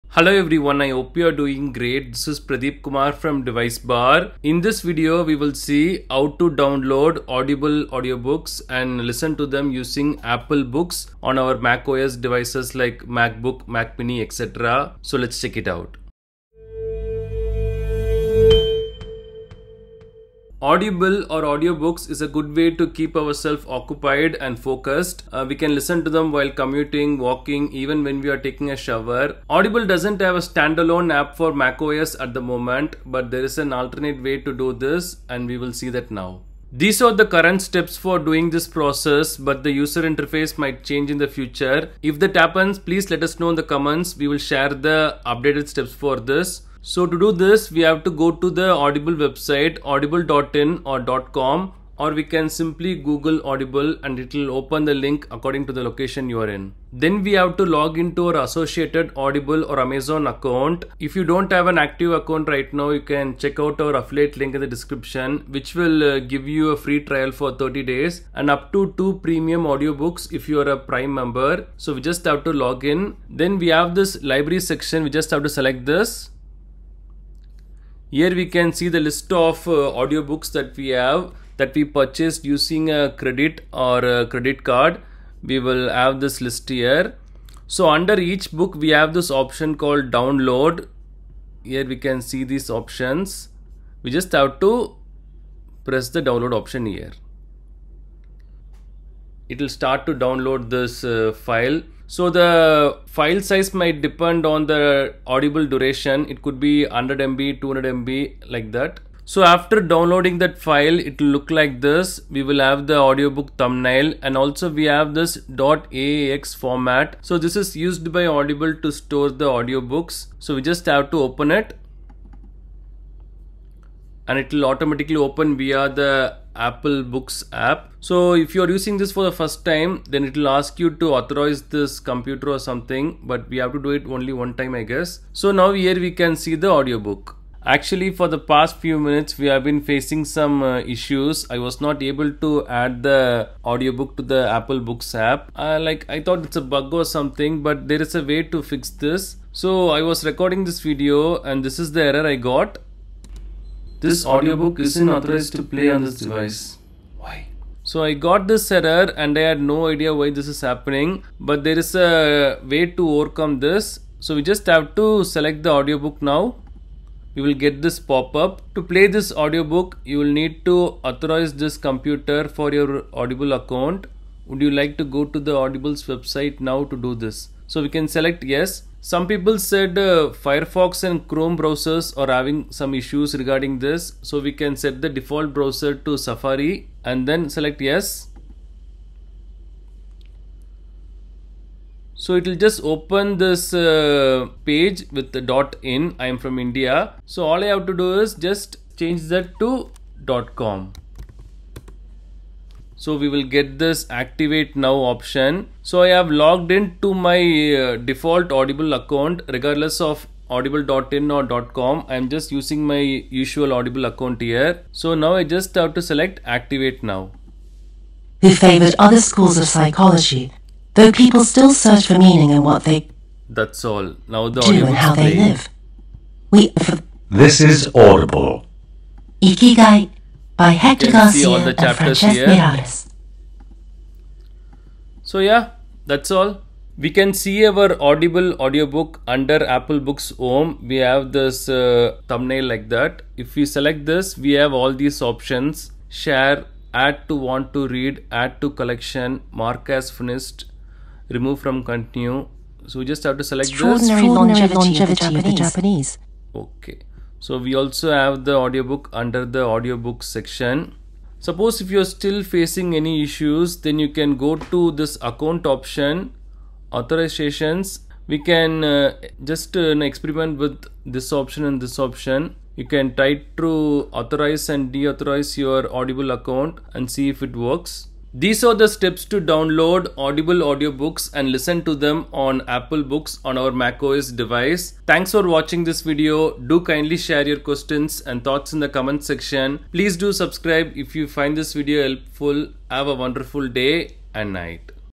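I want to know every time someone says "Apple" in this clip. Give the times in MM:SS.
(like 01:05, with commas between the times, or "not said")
00:10, 02:06, 02:24, 03:59, 04:42.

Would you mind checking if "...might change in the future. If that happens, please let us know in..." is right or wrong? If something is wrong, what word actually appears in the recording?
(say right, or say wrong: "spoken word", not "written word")
right.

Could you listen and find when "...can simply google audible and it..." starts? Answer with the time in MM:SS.
00:52.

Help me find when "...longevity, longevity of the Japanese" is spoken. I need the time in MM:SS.
04:14.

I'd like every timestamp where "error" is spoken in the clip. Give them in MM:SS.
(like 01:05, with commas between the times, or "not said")
02:32, 02:38.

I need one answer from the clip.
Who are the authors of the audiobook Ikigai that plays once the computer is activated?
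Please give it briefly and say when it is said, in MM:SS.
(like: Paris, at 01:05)
Hector Garcia and Francesc Miralles, at 03:50.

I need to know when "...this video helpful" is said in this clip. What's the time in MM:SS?
04:51.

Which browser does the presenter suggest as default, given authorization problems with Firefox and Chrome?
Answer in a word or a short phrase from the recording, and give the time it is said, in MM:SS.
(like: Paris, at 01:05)
Safari, at 03:06.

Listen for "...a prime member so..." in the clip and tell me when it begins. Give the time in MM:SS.
01:10.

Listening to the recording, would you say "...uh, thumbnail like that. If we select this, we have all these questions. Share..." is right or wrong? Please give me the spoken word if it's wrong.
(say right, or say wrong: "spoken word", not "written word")
wrong: "options", not "questions".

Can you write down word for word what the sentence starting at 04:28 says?
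We can uh, just uh, experiment with this option and this option.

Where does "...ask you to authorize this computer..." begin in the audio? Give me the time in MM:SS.
02:10.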